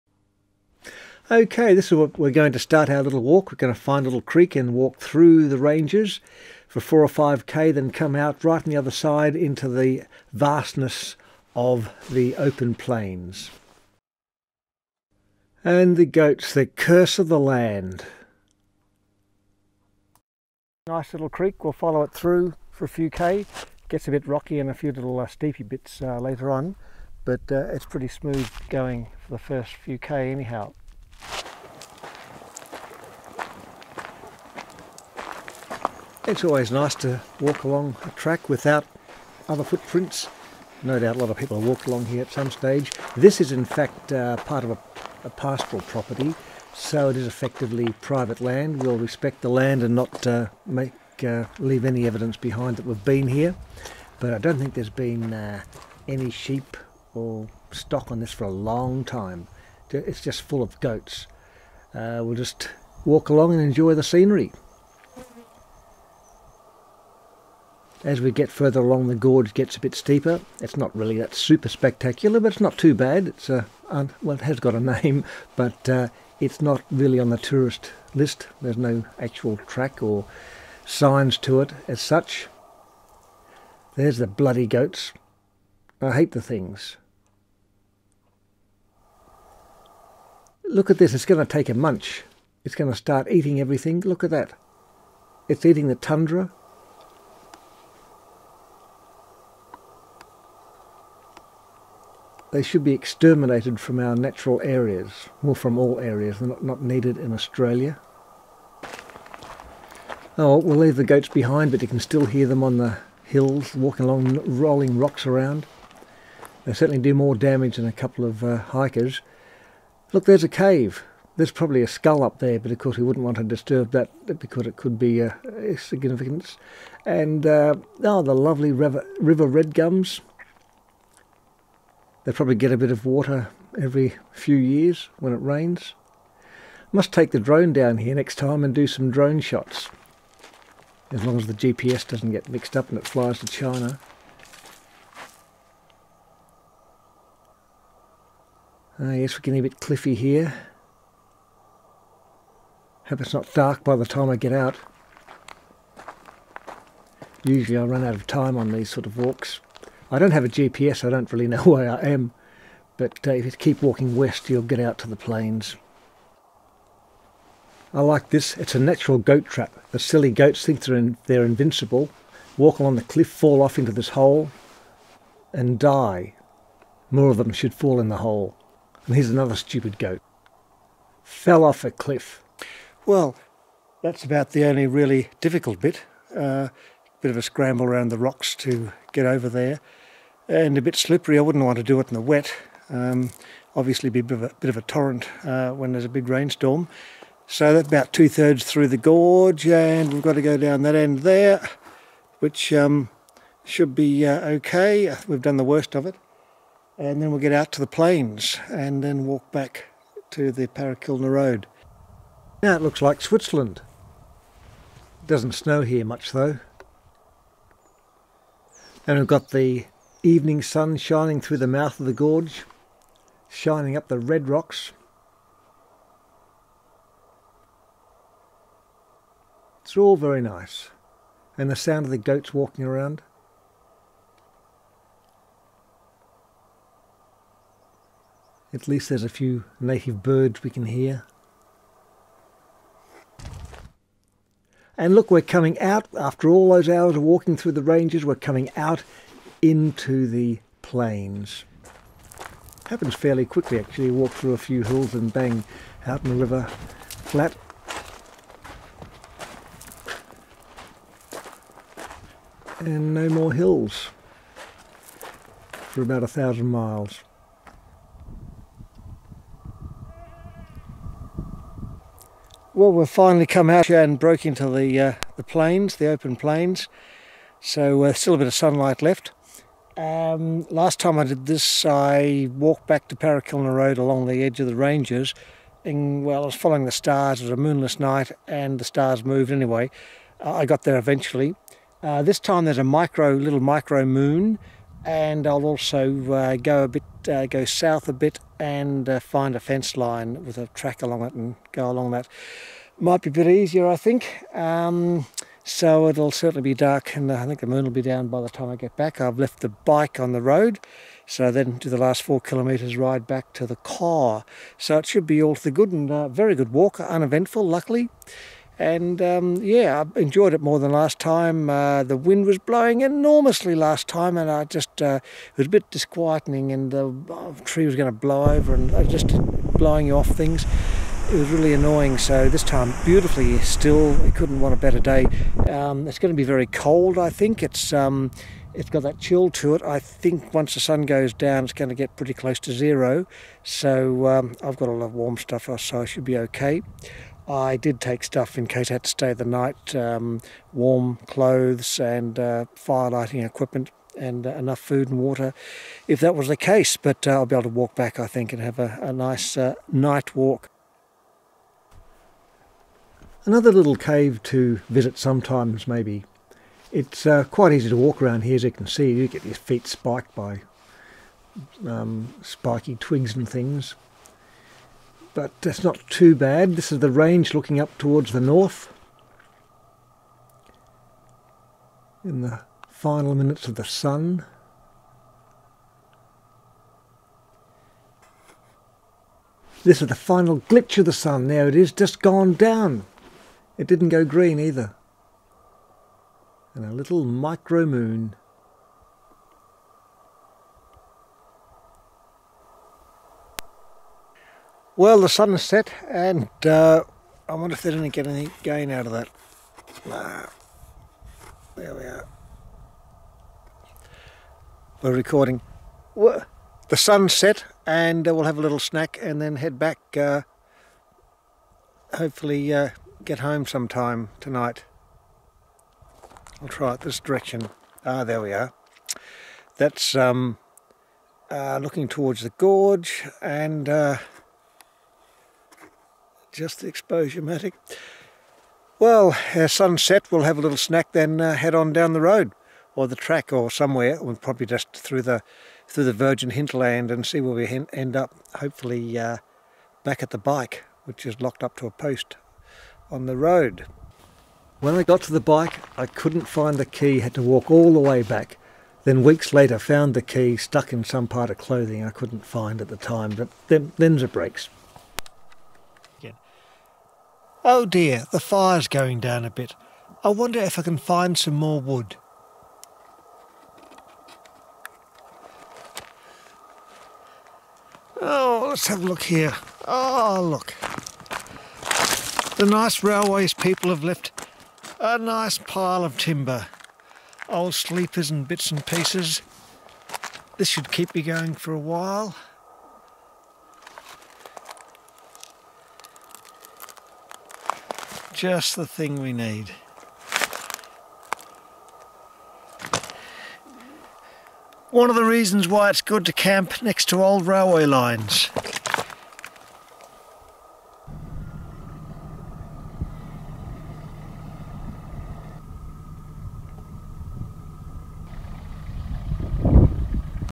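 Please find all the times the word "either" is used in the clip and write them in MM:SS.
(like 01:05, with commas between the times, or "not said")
06:34.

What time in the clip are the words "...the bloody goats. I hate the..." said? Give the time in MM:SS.
01:24.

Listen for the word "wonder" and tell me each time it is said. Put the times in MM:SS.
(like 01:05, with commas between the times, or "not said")
06:47, 07:50.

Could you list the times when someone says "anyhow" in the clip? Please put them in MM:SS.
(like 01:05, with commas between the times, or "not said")
00:30.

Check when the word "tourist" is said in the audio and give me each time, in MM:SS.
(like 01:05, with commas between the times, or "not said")
01:17.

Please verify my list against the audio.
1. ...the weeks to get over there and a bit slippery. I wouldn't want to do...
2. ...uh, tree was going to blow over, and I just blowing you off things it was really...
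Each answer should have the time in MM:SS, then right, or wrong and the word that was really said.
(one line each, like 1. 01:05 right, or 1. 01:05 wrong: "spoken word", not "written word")
1. 03:08 wrong: "rocks", not "weeks"
2. 05:27 right.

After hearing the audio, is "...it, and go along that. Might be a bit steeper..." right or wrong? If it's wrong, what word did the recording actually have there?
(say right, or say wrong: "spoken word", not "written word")
wrong: "easier", not "steeper".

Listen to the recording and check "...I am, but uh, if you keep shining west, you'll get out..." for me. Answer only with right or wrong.
wrong.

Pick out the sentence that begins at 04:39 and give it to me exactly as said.
Um, last time I did this, I walked back to Parachilna Road along the edge of the ranges.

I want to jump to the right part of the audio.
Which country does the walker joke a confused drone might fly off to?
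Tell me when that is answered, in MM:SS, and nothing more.
02:23.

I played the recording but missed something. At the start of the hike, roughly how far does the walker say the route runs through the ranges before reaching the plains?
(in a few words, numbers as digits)
4 or 5 km.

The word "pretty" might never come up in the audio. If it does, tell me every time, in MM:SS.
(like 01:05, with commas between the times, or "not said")
00:27, 05:42.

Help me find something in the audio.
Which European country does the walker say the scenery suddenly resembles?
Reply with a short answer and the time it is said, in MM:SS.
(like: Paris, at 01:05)
Switzerland, at 03:33.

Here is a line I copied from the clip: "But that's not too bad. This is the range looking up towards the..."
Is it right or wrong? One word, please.
right.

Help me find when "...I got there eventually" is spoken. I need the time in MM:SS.
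04:50.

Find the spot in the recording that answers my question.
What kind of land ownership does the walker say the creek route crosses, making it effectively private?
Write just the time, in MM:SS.
00:45.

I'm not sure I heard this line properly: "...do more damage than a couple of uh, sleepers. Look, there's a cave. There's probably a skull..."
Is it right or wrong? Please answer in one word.
wrong.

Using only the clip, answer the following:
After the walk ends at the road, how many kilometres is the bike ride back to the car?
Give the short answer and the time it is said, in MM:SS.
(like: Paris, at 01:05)
4 km, at 05:12.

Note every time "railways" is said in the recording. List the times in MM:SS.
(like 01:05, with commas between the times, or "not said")
08:03, 08:27.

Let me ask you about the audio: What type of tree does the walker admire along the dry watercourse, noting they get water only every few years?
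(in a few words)
river gums.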